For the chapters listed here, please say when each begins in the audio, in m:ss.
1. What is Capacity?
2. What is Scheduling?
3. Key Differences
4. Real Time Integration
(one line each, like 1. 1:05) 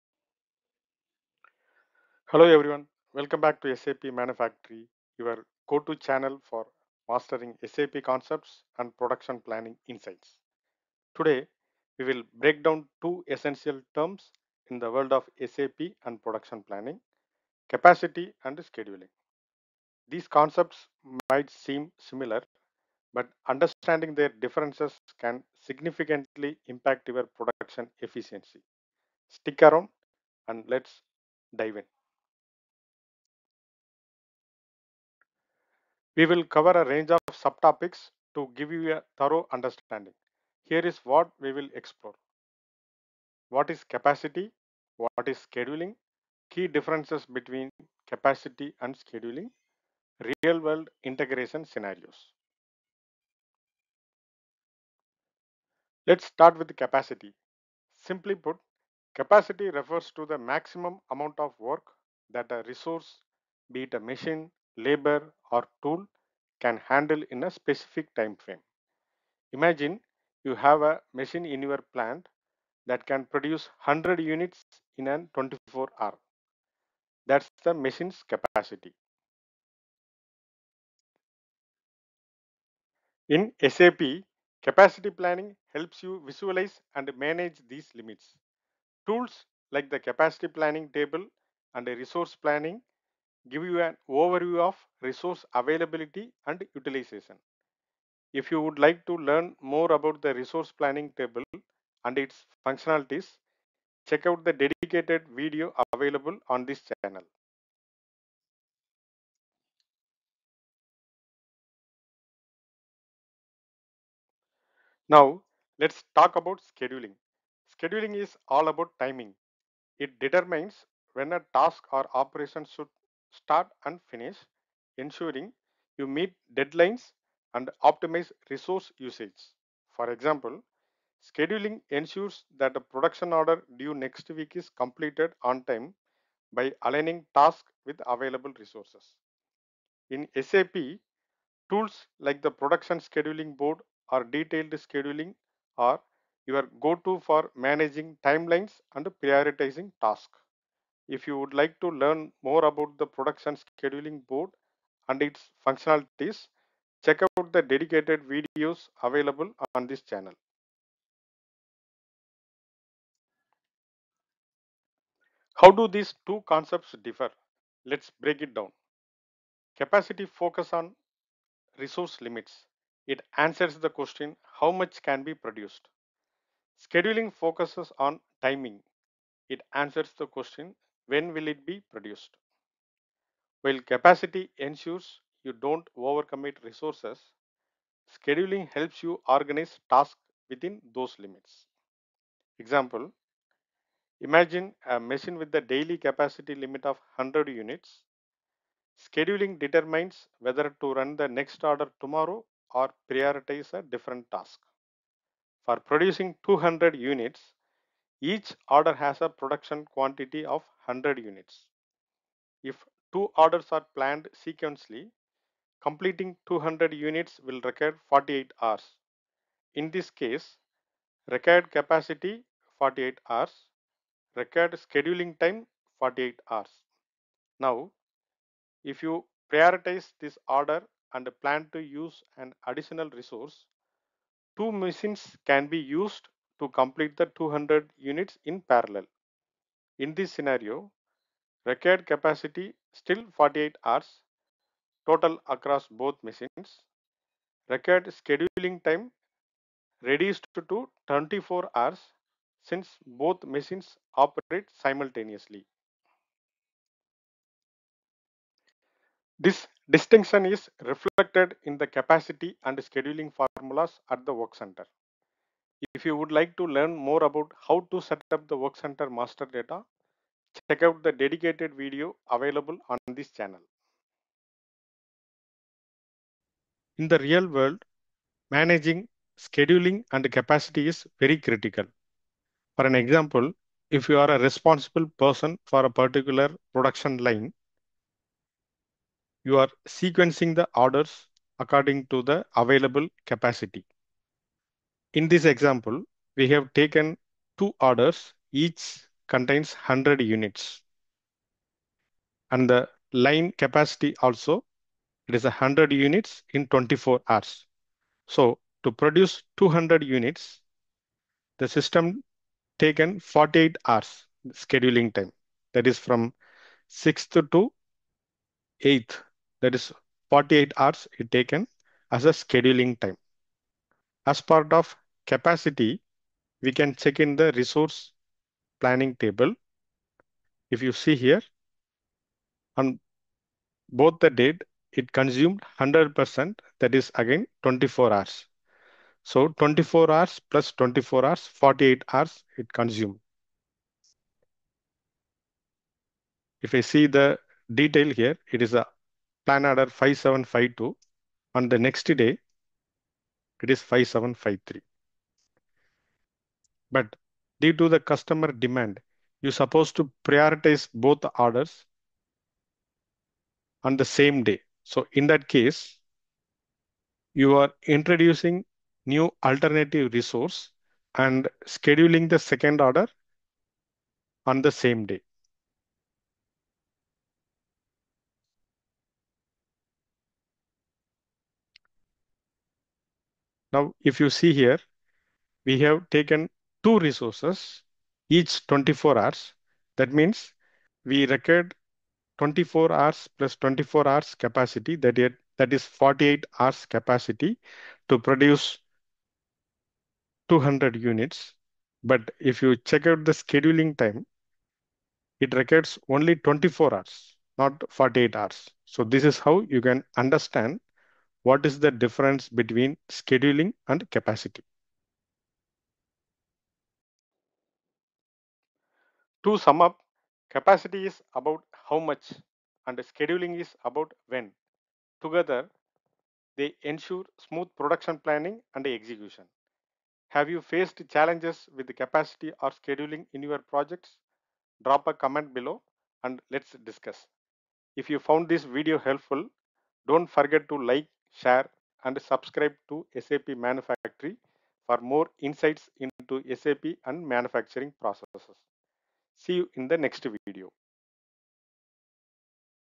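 1. 0:55
2. 1:50
3. 2:42
4. 4:34.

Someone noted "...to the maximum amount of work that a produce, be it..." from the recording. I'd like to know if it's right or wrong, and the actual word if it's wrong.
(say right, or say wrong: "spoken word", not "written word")
wrong: "resource", not "produce".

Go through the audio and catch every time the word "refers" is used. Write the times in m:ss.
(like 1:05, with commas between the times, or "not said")
0:59.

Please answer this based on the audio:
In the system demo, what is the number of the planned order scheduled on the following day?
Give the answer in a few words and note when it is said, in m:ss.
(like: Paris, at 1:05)
5753, at 5:53.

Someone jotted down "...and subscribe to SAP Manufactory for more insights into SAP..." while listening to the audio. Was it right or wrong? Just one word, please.
right.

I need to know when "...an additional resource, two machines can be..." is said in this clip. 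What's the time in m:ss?
3:52.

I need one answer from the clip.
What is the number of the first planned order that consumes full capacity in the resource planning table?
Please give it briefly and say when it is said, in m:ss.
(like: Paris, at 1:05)
5752, at 5:49.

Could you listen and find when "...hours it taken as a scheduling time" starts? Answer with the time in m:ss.
5:20.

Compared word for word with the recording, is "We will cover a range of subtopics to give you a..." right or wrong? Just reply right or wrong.
right.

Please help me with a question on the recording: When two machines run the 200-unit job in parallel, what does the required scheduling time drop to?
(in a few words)
24 hours.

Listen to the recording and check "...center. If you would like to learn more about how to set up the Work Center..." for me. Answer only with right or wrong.
right.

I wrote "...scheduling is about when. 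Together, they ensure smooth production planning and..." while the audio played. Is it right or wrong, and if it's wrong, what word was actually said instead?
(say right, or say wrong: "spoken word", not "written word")
right.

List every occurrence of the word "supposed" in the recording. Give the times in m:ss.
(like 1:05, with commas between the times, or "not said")
5:59.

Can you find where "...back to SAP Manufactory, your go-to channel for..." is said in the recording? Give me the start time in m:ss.
0:03.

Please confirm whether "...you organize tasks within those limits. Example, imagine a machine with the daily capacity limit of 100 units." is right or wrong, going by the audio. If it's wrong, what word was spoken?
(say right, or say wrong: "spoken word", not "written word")
right.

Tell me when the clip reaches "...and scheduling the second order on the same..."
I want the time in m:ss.
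6:11.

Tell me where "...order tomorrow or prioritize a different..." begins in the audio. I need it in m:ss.
3:21.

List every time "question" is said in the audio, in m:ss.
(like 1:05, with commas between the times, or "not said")
2:53, 3:00.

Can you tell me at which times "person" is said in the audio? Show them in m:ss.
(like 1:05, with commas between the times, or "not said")
4:45.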